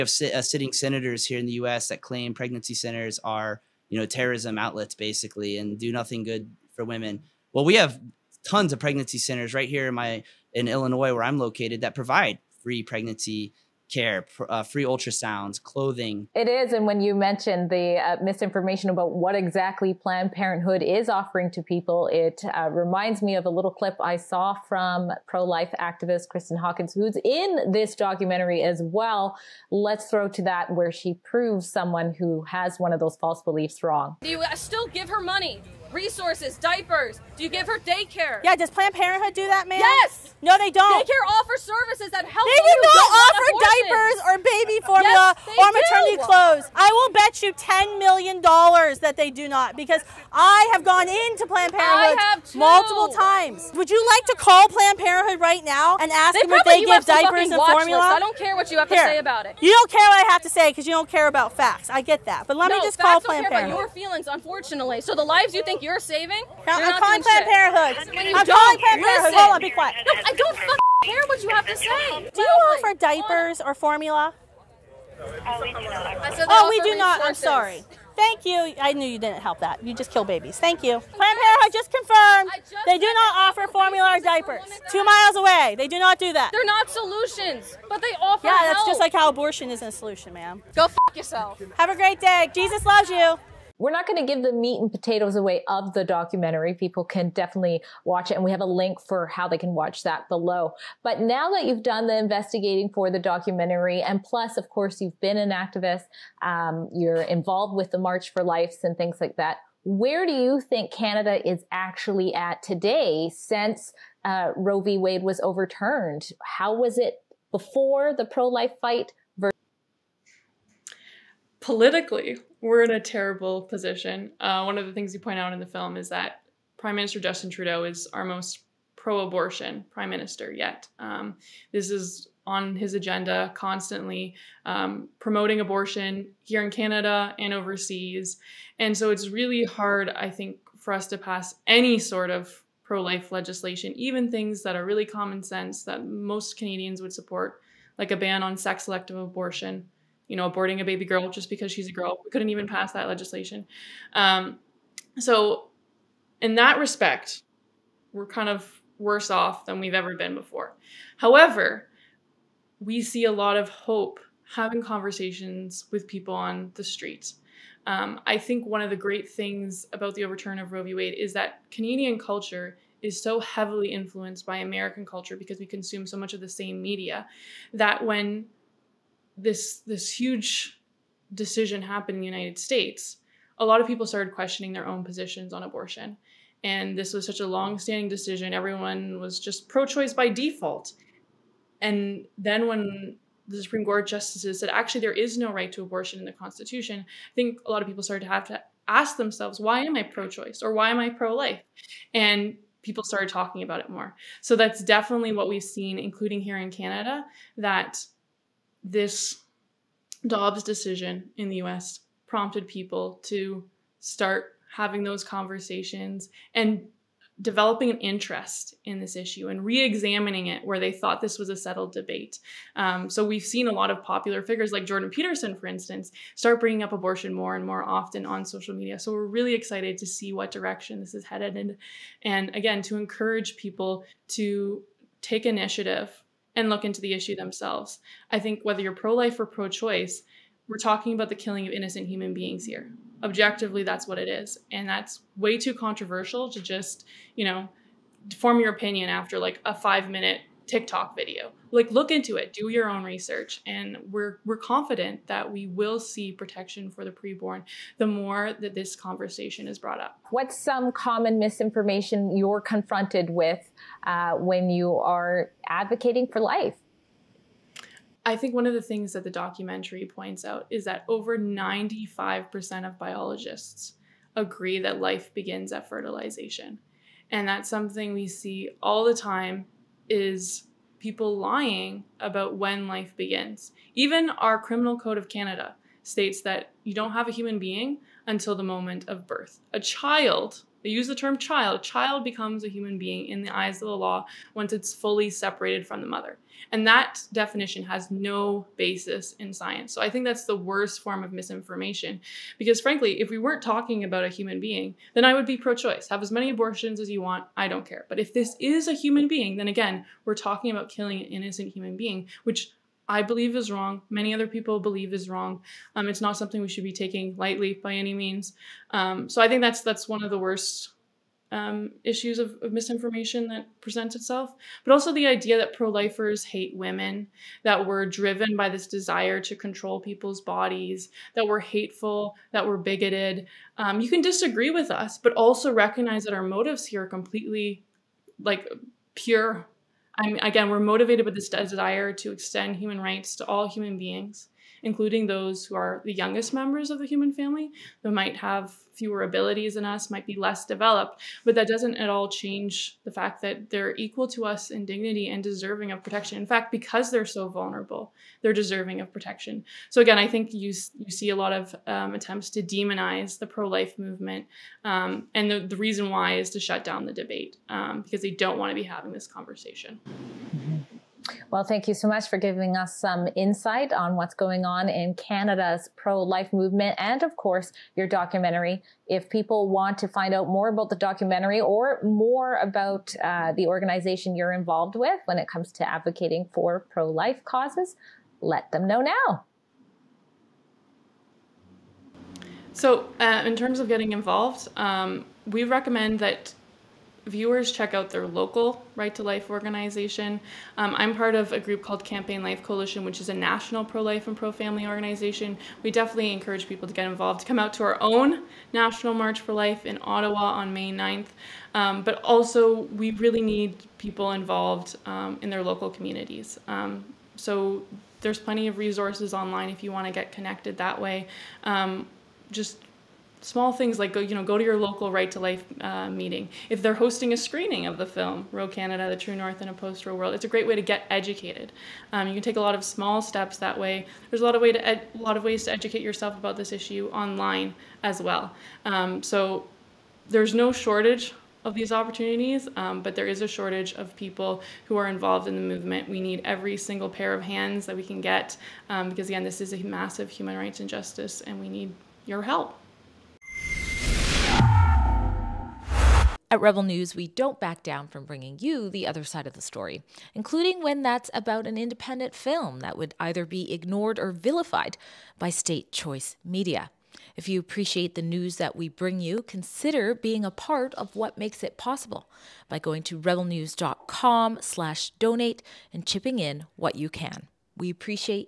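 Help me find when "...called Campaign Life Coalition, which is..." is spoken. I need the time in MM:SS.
06:41.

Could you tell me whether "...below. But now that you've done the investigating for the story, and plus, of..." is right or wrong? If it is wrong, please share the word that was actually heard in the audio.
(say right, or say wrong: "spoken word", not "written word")
wrong: "documentary", not "story".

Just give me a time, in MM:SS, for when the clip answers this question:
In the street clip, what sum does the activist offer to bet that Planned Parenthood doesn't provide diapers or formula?
00:47.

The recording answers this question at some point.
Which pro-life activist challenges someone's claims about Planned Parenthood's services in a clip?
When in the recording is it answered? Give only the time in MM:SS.
00:26.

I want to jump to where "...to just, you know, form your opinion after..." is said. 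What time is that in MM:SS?
04:06.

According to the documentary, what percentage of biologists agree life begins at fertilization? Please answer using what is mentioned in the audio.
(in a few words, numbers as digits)
95%.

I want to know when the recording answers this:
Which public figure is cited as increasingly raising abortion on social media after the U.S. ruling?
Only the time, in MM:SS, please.
03:44.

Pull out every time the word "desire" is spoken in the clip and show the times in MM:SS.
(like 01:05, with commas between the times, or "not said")
05:28, 05:41.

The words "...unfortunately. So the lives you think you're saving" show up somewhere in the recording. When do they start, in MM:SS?
01:04.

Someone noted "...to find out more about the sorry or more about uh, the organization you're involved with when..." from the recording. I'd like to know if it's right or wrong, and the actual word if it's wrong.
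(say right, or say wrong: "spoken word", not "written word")
wrong: "documentary", not "sorry".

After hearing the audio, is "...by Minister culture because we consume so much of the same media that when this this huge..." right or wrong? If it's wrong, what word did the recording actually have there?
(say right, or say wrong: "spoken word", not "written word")
wrong: "American", not "Minister".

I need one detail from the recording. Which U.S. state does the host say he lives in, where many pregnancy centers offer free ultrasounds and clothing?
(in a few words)
Illinois.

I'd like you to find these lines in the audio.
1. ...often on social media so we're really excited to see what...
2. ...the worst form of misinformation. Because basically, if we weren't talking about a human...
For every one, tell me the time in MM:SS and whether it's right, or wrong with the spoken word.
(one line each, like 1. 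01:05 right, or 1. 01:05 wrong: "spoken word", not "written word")
1. 03:47 right
2. 05:00 wrong: "frankly", not "basically".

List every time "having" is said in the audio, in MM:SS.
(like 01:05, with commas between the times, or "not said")
02:44, 03:34, 06:08.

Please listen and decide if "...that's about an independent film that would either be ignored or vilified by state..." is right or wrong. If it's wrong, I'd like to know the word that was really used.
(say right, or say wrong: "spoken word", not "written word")
right.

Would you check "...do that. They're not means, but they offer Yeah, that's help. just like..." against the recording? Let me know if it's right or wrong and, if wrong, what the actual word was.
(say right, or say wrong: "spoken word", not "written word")
wrong: "solutions", not "means".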